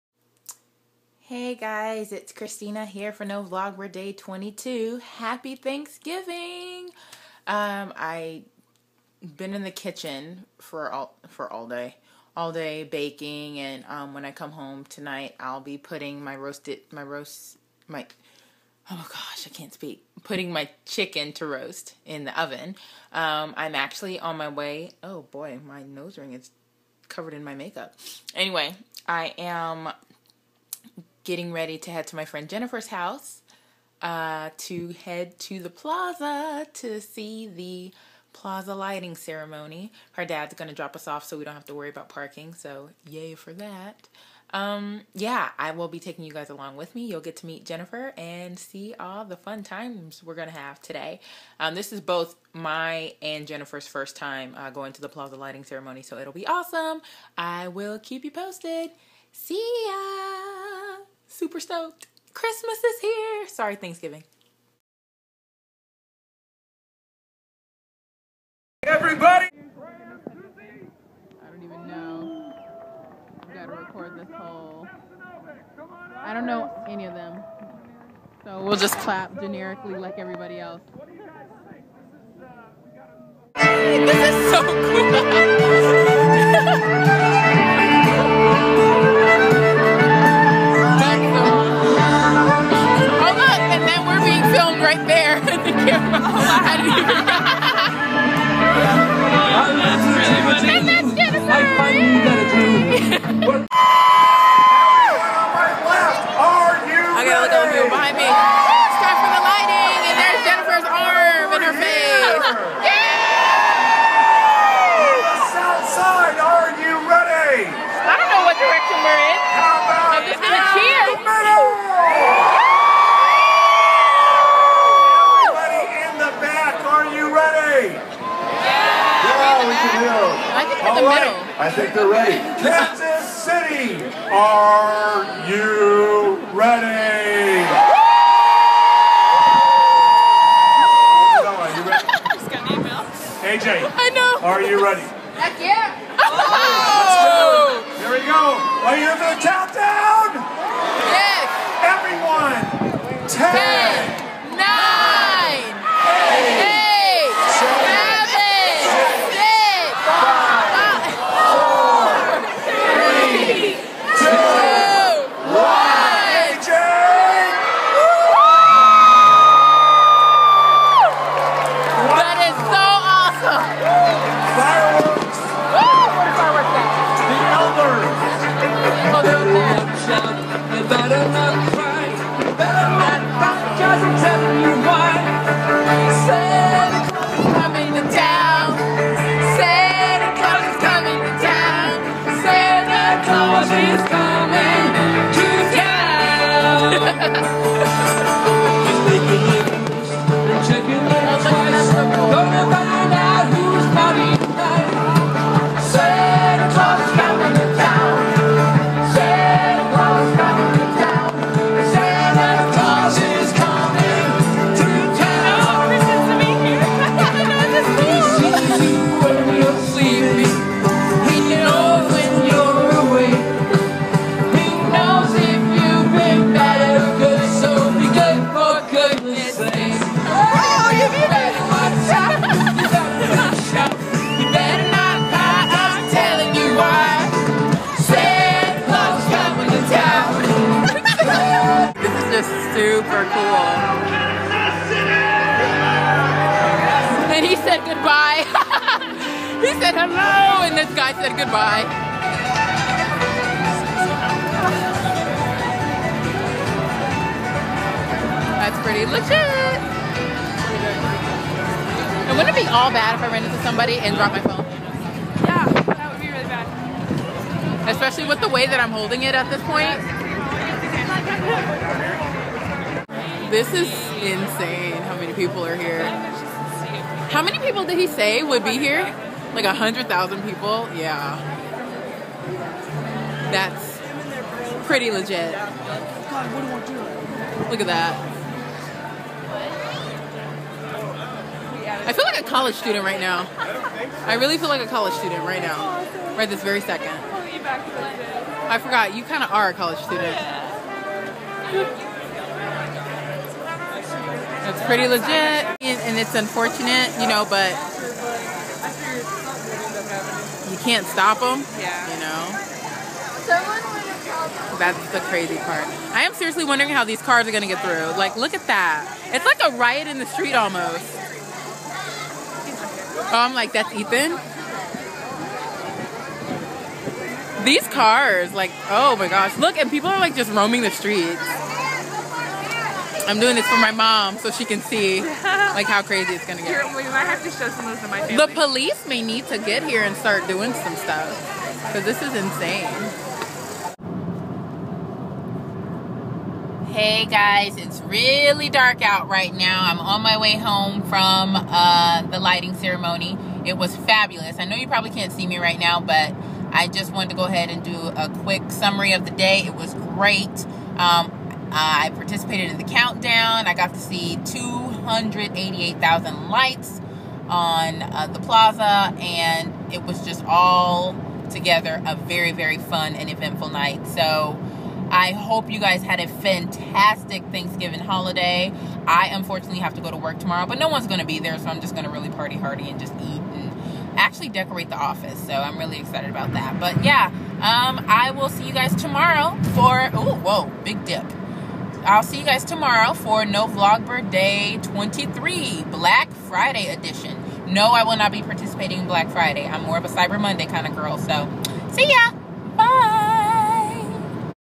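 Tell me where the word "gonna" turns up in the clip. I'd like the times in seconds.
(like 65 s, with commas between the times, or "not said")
317 s, 336 s.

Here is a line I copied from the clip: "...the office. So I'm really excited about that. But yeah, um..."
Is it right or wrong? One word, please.
right.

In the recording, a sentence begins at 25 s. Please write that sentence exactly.
Oh boy, my nose ring is covered in my makeup.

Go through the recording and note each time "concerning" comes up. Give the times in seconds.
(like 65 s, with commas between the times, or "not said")
not said.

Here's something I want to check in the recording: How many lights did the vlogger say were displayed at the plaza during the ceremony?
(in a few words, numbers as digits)
288,000.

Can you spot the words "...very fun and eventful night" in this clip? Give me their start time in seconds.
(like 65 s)
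372 s.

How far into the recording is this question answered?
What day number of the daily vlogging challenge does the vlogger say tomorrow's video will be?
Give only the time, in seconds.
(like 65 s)
394 s.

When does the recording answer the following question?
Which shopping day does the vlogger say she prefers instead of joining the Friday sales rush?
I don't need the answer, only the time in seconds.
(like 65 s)
400 s.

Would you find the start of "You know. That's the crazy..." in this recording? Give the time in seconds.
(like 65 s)
312 s.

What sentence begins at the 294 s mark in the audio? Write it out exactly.
I really feel like a college student right now.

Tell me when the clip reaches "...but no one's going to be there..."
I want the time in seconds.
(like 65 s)
380 s.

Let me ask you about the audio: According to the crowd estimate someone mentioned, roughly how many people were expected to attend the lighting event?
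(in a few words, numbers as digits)
100,000.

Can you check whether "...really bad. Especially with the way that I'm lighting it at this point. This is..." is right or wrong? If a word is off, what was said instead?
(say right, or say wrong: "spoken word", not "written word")
wrong: "holding", not "lighting".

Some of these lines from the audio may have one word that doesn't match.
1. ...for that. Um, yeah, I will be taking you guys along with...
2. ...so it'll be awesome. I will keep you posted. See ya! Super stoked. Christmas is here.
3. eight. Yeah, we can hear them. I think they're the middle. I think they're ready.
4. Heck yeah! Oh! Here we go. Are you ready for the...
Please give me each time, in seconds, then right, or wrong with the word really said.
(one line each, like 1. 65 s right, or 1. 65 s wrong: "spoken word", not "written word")
1. 43 s right
2. 56 s right
3. 127 s wrong: "three", not "eight"
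4. 145 s right.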